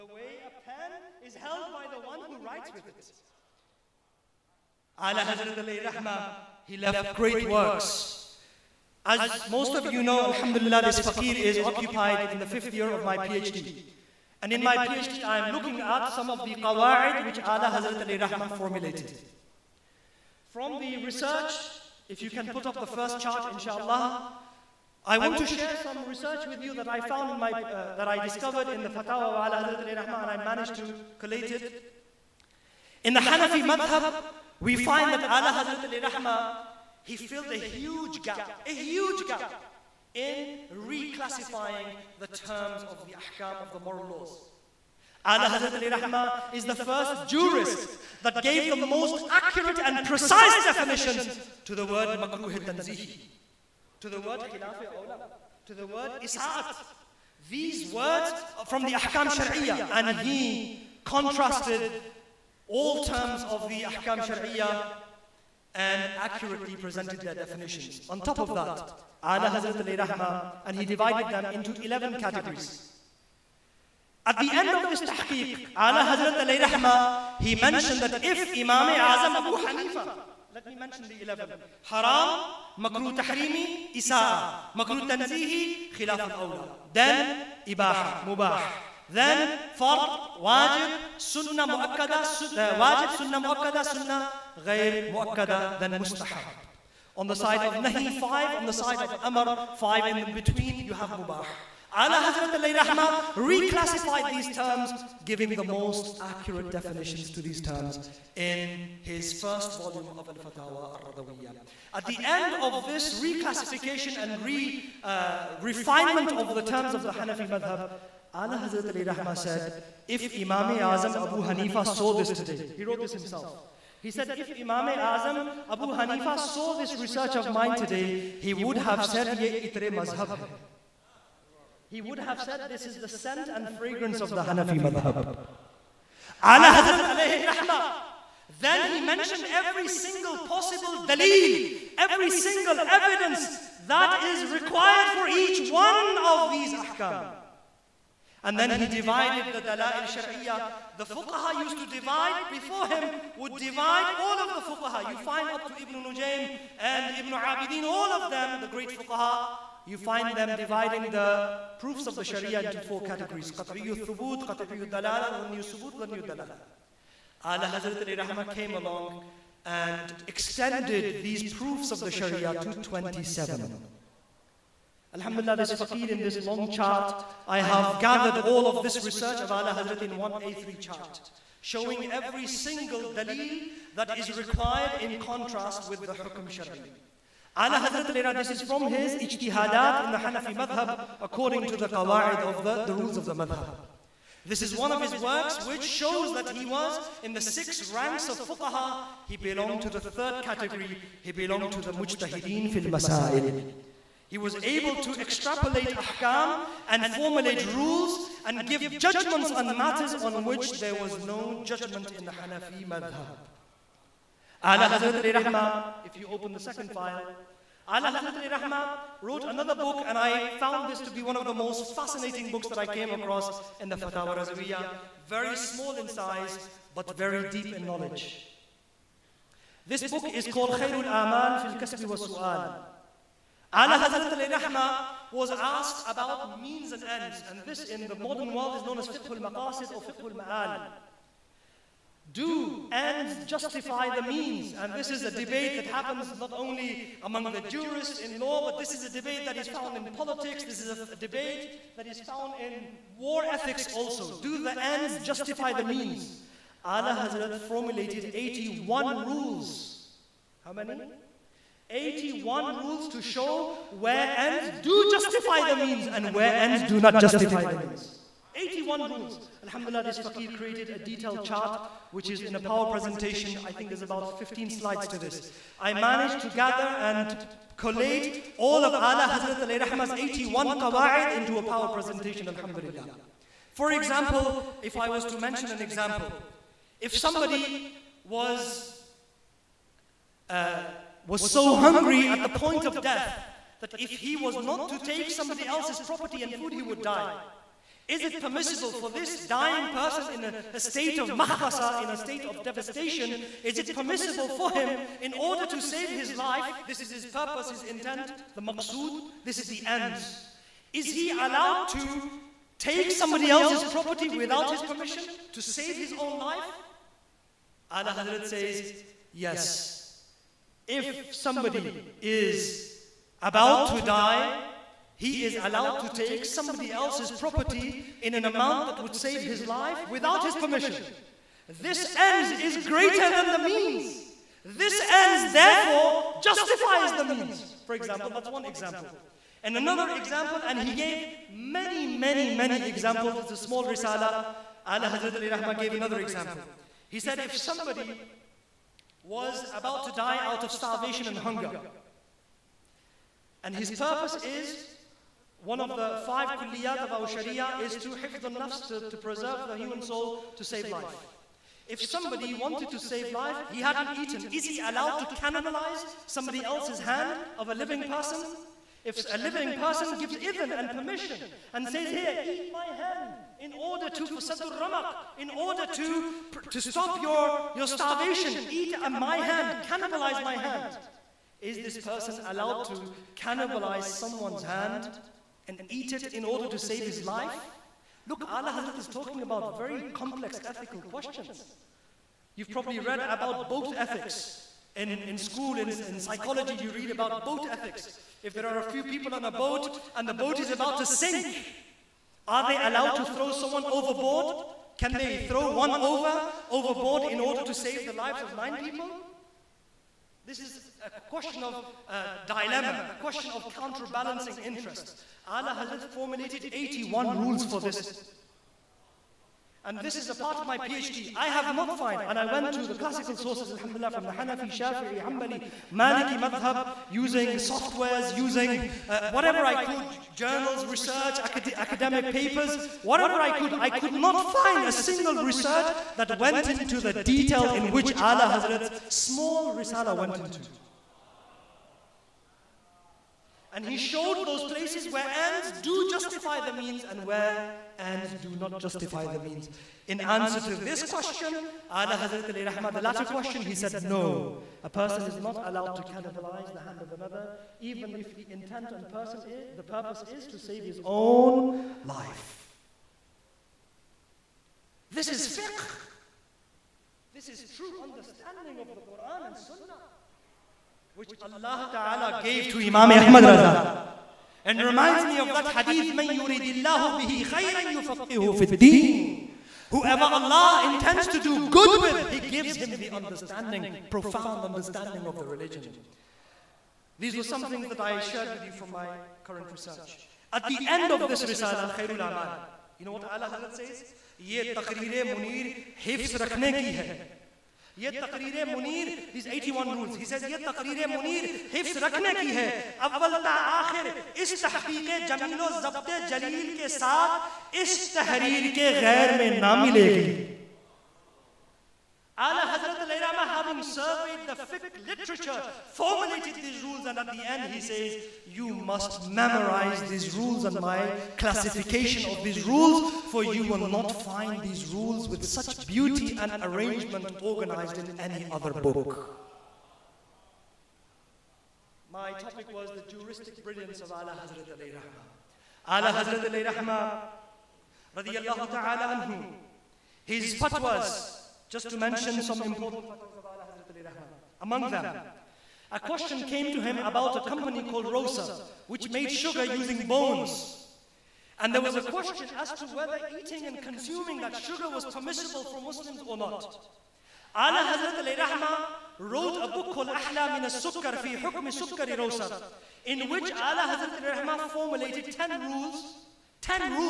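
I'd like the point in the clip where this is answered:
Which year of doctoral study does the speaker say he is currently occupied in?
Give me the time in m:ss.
0:12.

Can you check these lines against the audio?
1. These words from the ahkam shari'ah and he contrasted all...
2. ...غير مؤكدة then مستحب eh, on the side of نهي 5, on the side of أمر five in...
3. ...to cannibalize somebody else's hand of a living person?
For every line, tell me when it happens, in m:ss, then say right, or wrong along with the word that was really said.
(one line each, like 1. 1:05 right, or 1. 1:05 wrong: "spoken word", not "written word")
1. 0:57 right
2. 1:34 right
3. 6:05 right.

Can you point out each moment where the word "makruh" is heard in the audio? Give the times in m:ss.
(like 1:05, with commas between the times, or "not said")
0:52.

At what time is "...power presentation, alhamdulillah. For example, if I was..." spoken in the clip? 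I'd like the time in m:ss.
4:41.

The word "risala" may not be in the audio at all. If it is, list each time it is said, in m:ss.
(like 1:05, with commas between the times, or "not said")
5:43, 7:19, 8:11.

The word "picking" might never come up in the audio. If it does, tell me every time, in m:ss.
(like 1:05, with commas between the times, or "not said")
not said.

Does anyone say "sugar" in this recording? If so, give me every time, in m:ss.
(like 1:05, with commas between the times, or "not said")
9:09, 9:14.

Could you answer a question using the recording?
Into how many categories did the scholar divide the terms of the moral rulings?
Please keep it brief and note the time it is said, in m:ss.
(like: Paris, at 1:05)
11, at 1:11.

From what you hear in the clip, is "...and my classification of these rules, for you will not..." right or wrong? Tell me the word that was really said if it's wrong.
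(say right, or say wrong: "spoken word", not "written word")
right.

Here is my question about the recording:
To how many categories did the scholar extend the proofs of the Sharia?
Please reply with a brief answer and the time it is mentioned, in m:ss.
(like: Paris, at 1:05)
27, at 2:52.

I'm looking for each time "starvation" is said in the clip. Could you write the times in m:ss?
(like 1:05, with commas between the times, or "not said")
5:50, 6:17.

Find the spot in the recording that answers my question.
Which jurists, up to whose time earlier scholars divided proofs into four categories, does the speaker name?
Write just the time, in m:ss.
2:35.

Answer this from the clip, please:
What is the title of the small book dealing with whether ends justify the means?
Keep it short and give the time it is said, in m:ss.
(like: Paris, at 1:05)
Khairul Aman fil Kasbi wa Su'al, at 3:50.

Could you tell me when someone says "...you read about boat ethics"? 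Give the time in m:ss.
6:36.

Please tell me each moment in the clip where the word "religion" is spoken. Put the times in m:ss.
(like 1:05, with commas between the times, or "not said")
8:05.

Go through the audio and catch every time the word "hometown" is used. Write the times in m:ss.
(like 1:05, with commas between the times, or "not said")
not said.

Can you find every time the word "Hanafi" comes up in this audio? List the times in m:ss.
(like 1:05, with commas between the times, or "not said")
0:33, 1:57, 2:14, 3:10, 3:32, 7:04.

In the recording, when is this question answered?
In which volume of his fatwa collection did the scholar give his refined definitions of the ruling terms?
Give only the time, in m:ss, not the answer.
1:49.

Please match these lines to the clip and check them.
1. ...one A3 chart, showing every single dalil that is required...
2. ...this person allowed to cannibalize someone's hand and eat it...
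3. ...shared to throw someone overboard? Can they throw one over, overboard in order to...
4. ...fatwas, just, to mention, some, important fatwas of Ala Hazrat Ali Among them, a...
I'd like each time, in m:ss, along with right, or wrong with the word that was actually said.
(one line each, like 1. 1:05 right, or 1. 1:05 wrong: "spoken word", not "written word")
1. 3:00 right
2. 6:21 right
3. 6:42 wrong: "allowed", not "shared"
4. 9:00 right.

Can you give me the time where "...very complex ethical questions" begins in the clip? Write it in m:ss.
6:29.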